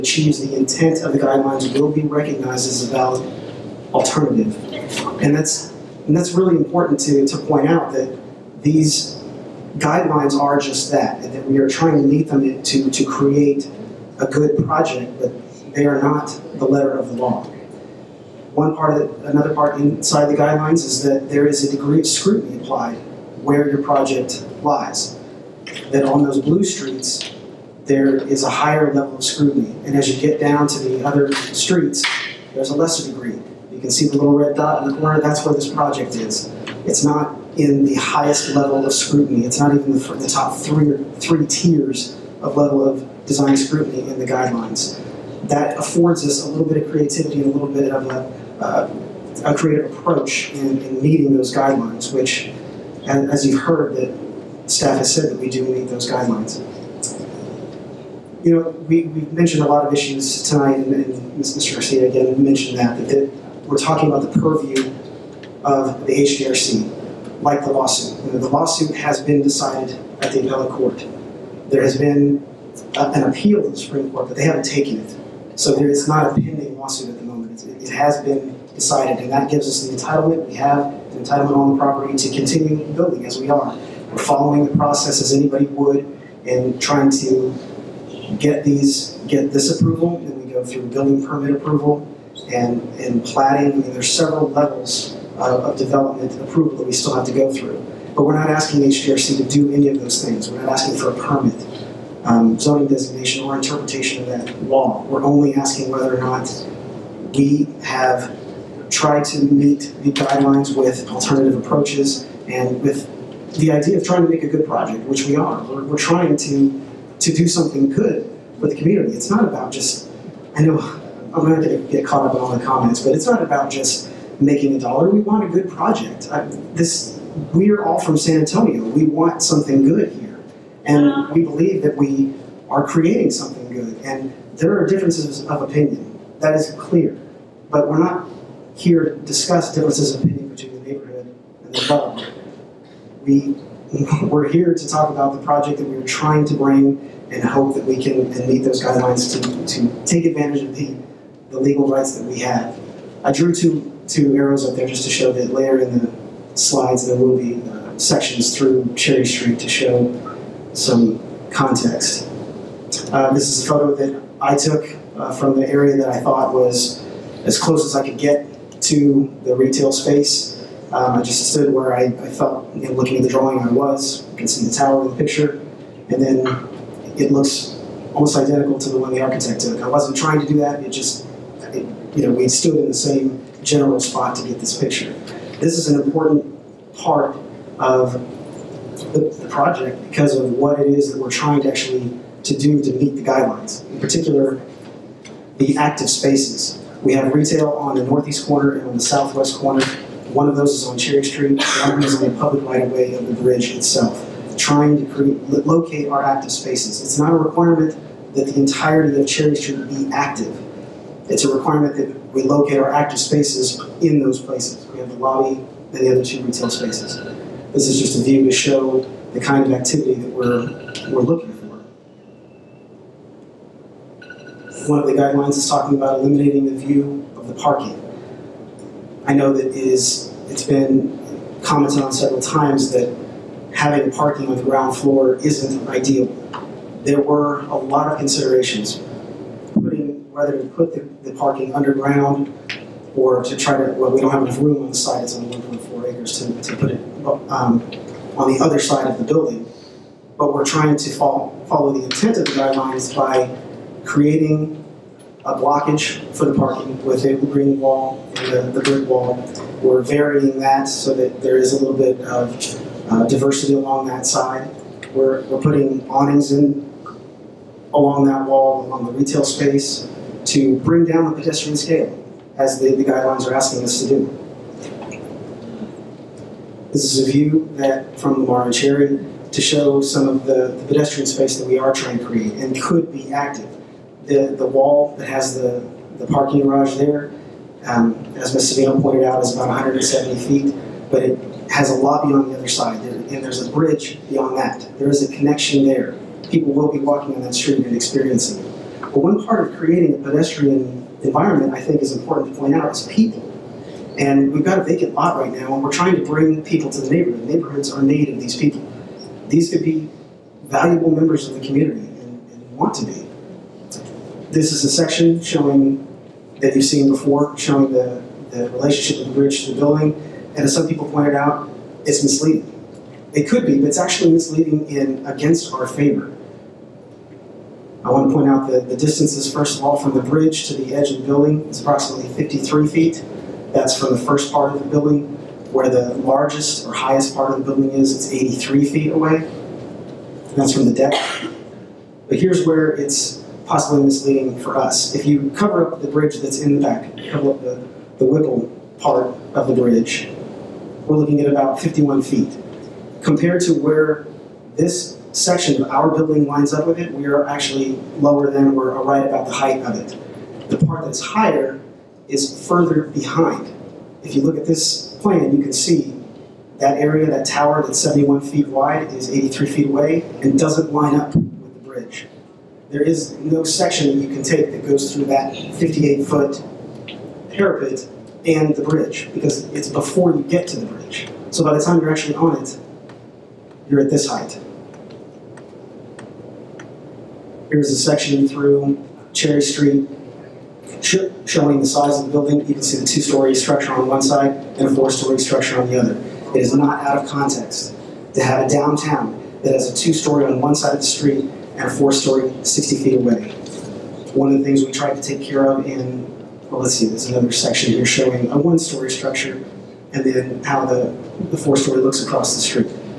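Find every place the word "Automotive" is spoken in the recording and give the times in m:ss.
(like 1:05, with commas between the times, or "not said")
not said.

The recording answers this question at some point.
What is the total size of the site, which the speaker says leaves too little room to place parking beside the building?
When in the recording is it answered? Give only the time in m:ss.
4:05.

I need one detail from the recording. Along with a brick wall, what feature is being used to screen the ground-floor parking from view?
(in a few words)
green wall.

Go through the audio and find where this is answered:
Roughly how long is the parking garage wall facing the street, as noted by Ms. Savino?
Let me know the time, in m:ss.
4:49.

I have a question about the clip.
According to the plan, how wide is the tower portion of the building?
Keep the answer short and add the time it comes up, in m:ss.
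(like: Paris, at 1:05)
71 feet, at 6:07.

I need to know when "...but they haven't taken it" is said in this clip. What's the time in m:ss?
1:14.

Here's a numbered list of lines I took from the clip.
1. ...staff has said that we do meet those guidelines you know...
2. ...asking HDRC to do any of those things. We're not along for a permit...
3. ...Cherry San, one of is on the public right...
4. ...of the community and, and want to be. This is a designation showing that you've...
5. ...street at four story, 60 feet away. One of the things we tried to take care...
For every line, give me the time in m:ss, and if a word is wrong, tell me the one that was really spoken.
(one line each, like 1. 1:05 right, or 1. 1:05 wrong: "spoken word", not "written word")
1. 0:54 right
2. 1:38 wrong: "asking", not "along"
3. 3:20 wrong: "Street", not "San"
4. 5:11 wrong: "section", not "designation"
5. 6:41 right.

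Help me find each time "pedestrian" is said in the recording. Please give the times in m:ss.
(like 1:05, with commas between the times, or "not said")
4:31, 4:40, 5:00.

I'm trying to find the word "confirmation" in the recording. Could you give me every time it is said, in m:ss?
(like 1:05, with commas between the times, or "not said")
not said.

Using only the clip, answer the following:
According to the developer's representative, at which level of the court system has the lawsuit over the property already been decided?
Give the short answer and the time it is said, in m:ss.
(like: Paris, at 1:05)
appellate court, at 1:10.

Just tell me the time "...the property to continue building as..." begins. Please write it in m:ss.
1:21.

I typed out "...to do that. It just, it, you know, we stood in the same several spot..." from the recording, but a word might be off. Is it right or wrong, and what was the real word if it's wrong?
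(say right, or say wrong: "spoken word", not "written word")
wrong: "general", not "several".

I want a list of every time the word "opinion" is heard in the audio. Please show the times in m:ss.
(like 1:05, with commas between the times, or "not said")
2:15, 2:20.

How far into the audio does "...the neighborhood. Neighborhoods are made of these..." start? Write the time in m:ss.
5:06.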